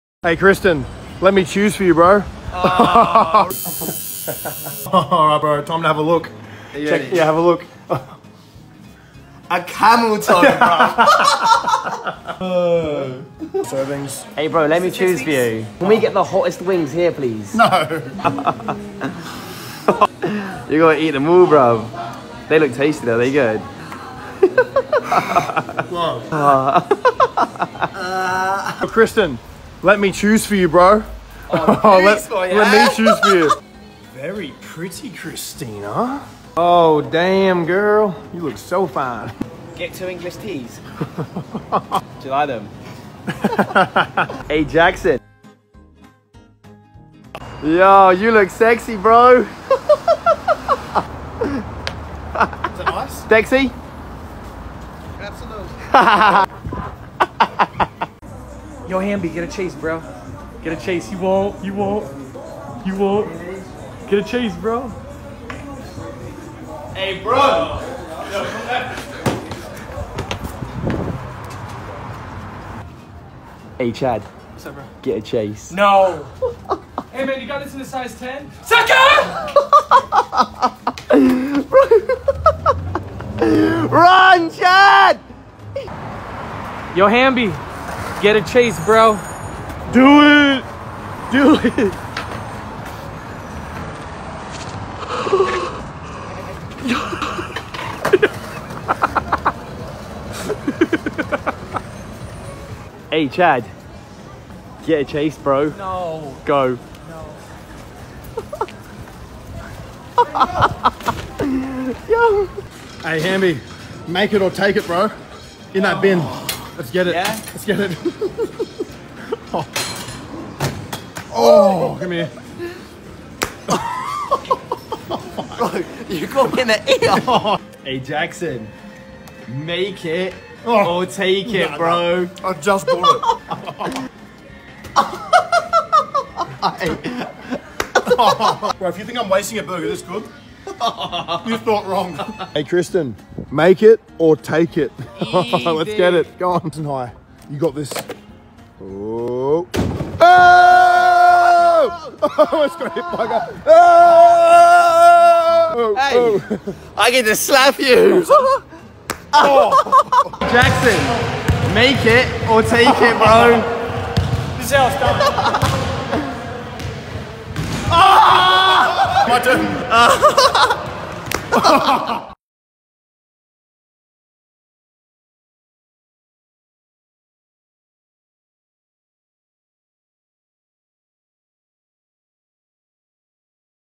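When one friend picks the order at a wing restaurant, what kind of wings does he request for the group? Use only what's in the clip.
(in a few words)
The hottest wings.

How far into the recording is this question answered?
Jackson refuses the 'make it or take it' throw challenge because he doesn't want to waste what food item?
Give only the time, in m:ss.
2:19.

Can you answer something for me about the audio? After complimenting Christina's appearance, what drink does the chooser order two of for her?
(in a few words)
English teas.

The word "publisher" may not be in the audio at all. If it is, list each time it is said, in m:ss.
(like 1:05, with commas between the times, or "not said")
not said.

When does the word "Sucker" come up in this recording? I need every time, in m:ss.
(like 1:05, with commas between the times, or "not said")
1:18.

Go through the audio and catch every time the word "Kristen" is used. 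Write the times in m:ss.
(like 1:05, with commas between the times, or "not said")
0:00, 0:28, 2:22.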